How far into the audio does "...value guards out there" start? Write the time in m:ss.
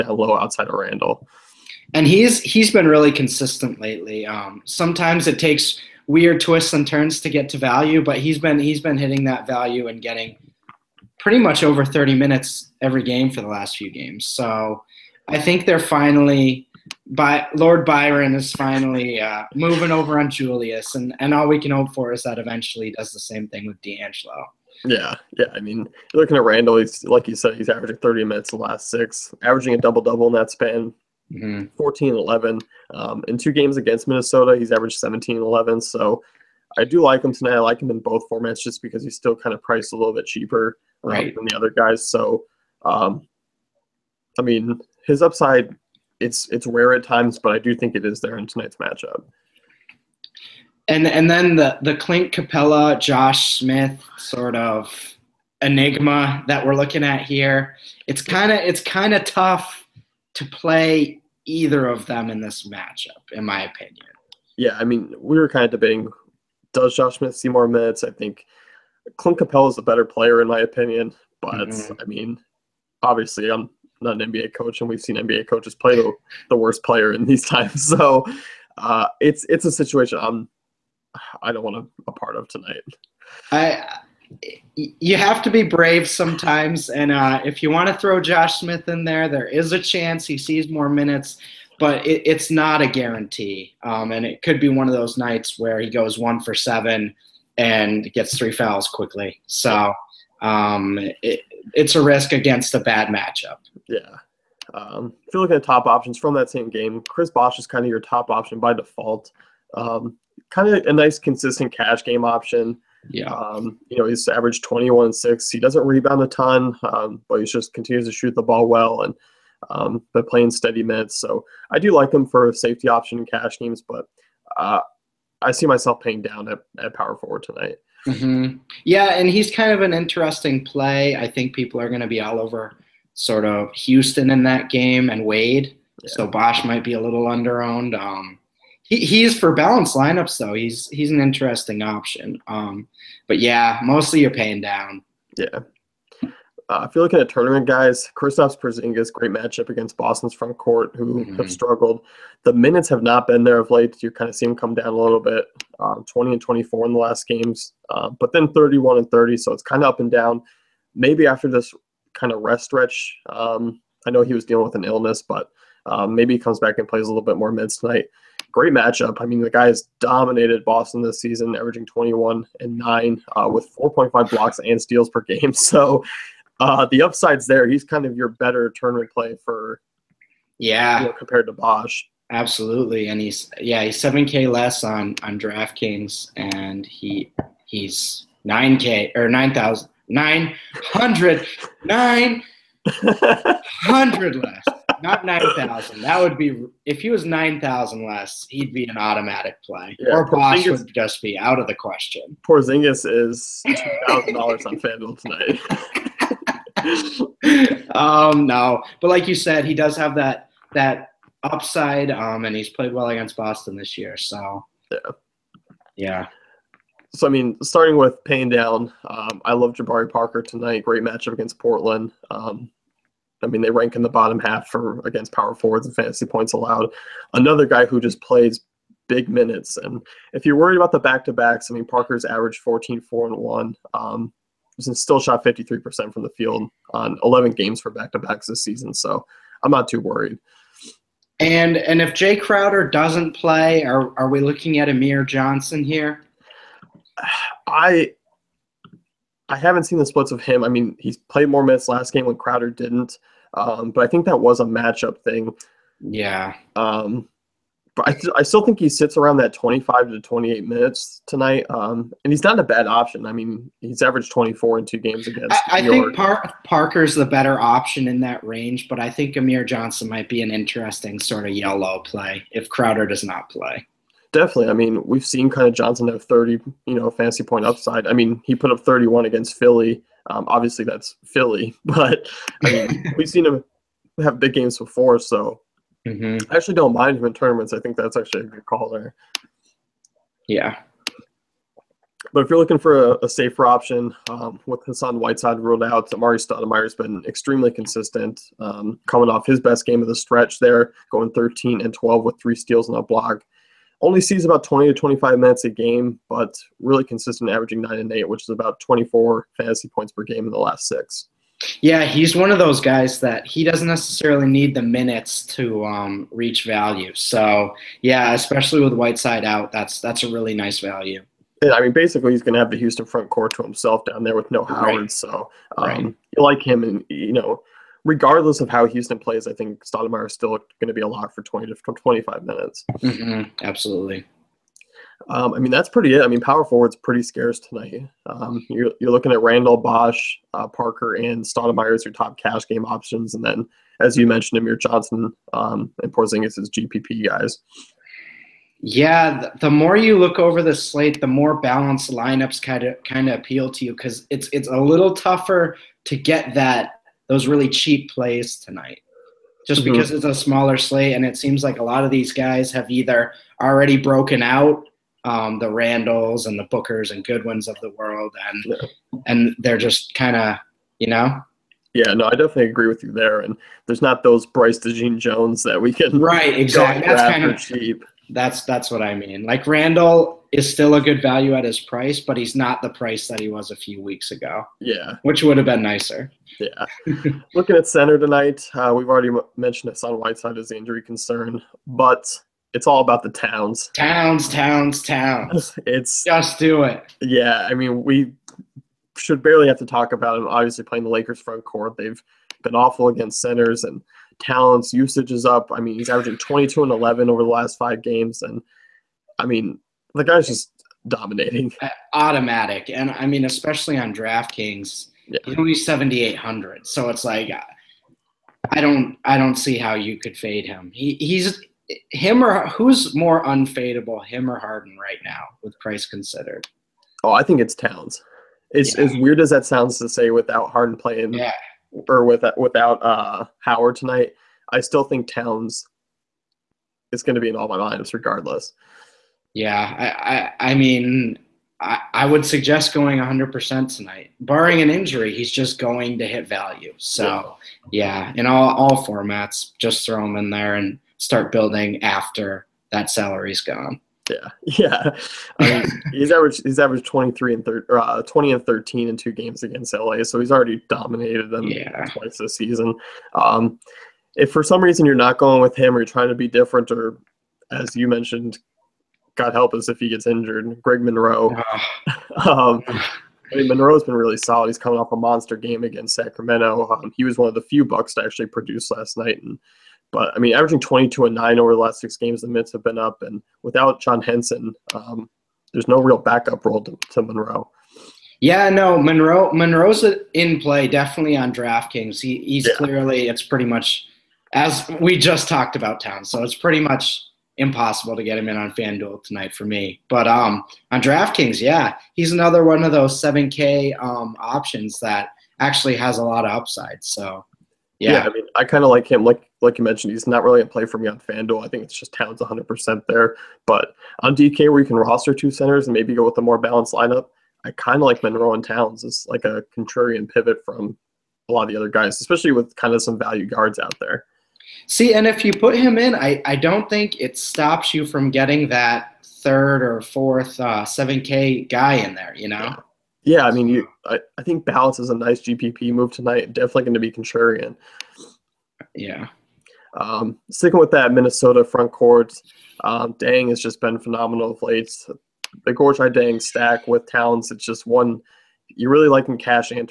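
8:43.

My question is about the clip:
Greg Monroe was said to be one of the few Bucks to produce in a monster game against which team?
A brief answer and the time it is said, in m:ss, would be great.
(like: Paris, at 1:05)
Sacramento, at 7:56.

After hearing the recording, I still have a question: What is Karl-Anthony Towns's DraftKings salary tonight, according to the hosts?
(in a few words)
7,800.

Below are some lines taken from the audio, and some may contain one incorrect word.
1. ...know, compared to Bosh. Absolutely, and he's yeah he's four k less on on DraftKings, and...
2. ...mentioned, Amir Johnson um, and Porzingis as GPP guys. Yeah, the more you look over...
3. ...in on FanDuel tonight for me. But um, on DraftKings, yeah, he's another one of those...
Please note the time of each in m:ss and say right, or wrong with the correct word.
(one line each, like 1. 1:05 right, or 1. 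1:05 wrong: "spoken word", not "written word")
1. 3:01 wrong: "seven", not "four"
2. 5:44 right
3. 8:18 right.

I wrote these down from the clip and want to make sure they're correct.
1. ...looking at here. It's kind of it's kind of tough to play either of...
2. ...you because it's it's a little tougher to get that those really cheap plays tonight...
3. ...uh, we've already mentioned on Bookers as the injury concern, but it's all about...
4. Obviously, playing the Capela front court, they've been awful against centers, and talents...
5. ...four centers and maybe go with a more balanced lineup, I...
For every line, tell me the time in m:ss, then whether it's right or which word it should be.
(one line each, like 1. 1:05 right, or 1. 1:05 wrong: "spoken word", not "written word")
1. 0:56 right
2. 5:53 right
3. 6:28 wrong: "Whiteside", not "Bookers"
4. 6:40 wrong: "Lakers", not "Capela"
5. 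8:35 wrong: "two", not "four".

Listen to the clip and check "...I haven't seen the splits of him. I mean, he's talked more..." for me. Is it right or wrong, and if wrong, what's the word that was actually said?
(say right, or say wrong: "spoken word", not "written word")
wrong: "played", not "talked".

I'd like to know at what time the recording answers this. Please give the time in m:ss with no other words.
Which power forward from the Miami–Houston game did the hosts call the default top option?
1:47.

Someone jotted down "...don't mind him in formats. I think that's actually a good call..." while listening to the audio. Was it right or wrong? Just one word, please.
wrong.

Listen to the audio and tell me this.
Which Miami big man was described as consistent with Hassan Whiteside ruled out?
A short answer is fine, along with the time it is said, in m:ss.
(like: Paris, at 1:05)
Amar'e Stoudemire, at 4:56.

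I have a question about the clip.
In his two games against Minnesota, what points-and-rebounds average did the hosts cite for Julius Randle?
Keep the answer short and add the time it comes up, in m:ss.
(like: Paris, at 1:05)
17 and 11, at 0:34.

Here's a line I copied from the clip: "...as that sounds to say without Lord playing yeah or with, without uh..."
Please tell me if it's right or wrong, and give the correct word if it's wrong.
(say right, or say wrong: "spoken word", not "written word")
wrong: "Harden", not "Lord".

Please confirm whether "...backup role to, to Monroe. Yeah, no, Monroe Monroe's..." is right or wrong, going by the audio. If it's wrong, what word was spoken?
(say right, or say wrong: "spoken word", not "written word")
right.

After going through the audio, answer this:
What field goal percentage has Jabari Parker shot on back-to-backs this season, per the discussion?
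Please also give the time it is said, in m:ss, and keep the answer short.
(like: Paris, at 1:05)
53%, at 3:55.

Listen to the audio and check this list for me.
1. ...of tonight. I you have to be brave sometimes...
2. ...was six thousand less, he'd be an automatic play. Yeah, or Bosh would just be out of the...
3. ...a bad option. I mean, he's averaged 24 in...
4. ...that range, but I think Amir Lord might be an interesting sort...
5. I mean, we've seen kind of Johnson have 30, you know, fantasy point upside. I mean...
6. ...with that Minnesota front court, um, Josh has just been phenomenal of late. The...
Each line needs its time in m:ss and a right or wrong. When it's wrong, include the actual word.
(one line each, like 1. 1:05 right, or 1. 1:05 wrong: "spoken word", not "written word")
1. 1:22 right
2. 3:17 wrong: "nine", not "six"
3. 4:22 right
4. 4:28 wrong: "Johnson", not "Lord"
5. 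4:34 right
6. 9:00 wrong: "Dieng", not "Josh".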